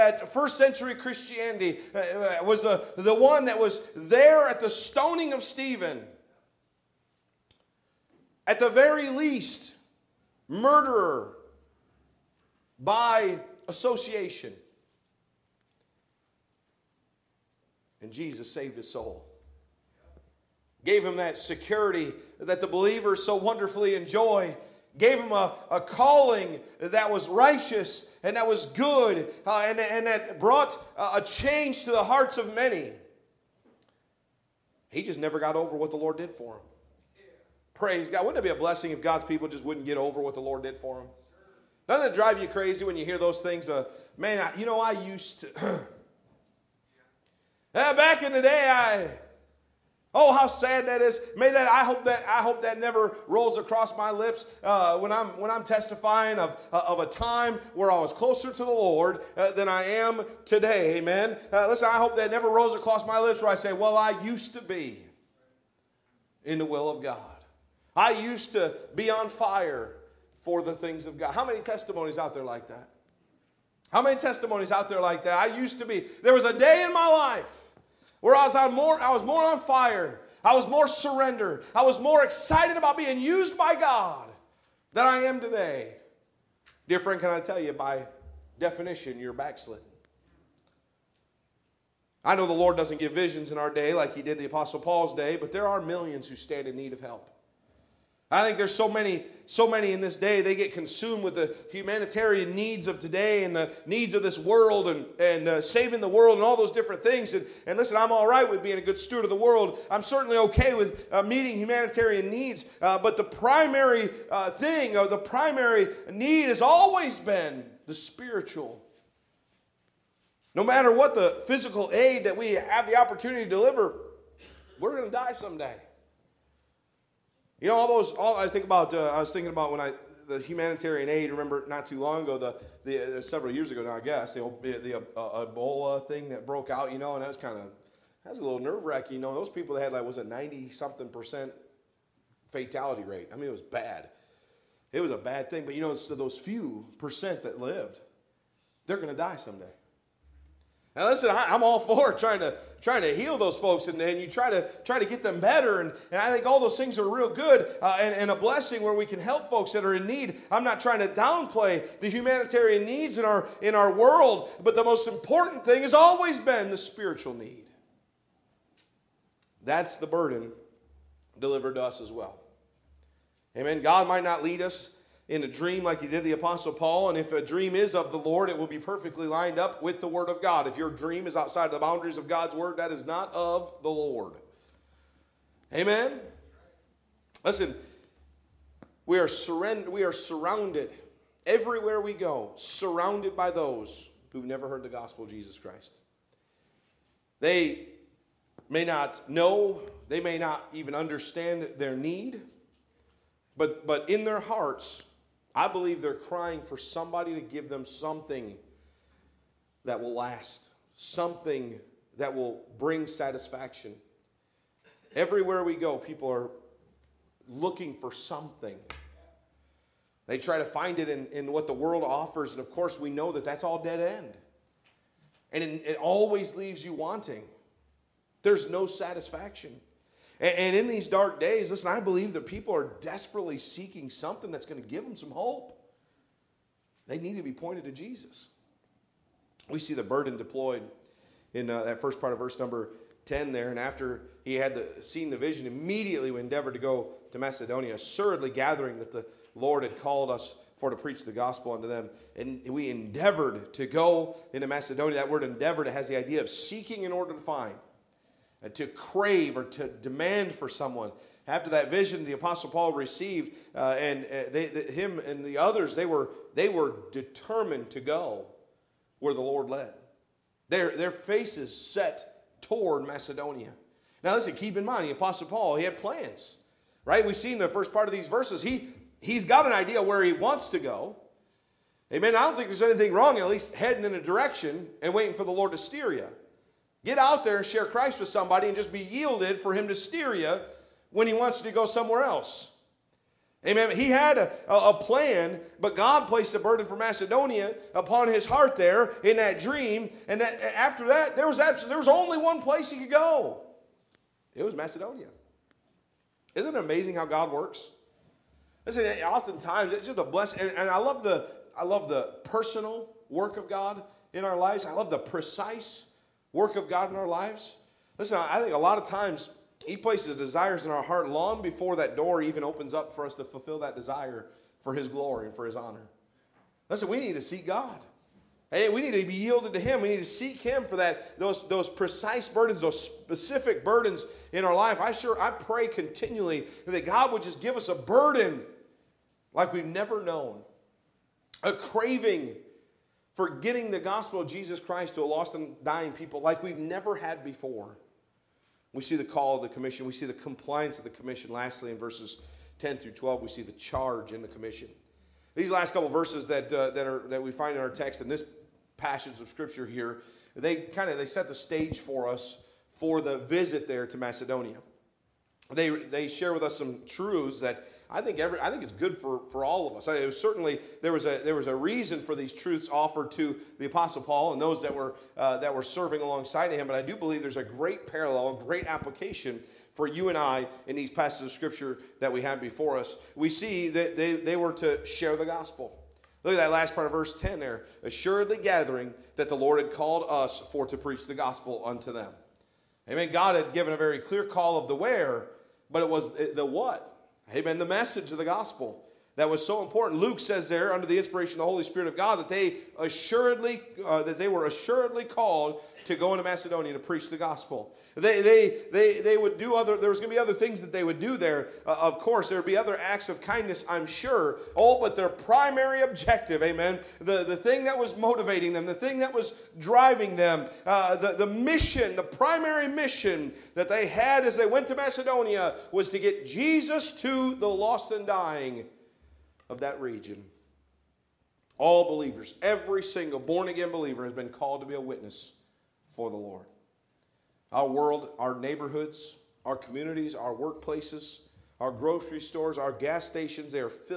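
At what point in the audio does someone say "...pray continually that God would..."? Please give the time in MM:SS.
05:35.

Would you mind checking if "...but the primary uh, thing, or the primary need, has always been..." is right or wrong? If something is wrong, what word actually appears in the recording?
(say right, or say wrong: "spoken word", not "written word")
right.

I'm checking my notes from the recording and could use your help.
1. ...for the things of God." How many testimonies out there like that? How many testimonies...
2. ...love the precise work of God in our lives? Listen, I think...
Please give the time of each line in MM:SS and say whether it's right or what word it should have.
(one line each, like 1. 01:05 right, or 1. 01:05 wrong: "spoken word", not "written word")
1. 01:10 right
2. 05:14 right.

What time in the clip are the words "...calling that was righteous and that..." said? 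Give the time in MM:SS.
00:25.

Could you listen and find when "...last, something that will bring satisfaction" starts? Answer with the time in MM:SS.
03:30.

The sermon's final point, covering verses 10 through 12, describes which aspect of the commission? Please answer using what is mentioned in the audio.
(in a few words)
charge.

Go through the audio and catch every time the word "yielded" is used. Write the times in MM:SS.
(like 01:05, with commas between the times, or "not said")
04:49, 05:29.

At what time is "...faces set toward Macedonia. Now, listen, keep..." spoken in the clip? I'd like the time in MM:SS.
04:31.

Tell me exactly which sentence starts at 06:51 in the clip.
Uh, of course, there would be other acts of kindness, I'm sure.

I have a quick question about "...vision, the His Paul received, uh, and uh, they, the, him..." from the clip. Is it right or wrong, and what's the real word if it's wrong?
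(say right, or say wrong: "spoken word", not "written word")
wrong: "Apostle", not "His".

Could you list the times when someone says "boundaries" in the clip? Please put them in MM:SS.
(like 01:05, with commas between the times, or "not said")
03:01.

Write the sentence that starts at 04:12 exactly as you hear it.
And we endeavored to go into Macedonia.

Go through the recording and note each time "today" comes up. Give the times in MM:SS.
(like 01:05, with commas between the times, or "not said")
01:00, 01:25, 01:42.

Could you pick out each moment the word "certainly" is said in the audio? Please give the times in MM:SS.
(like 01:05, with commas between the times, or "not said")
01:50, 06:10.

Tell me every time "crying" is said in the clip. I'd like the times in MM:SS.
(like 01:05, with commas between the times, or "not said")
03:26.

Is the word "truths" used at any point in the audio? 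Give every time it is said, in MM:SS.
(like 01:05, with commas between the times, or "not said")
06:07, 06:12.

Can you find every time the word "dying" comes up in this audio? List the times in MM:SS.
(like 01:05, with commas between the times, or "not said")
05:45, 07:08.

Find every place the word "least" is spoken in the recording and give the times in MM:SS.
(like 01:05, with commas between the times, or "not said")
00:09, 04:43.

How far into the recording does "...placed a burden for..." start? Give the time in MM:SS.
04:56.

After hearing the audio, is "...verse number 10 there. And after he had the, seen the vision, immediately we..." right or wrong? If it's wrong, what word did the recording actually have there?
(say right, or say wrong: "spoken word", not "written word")
right.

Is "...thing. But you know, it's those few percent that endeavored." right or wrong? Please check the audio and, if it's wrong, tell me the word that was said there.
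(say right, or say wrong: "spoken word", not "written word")
wrong: "lived", not "endeavored".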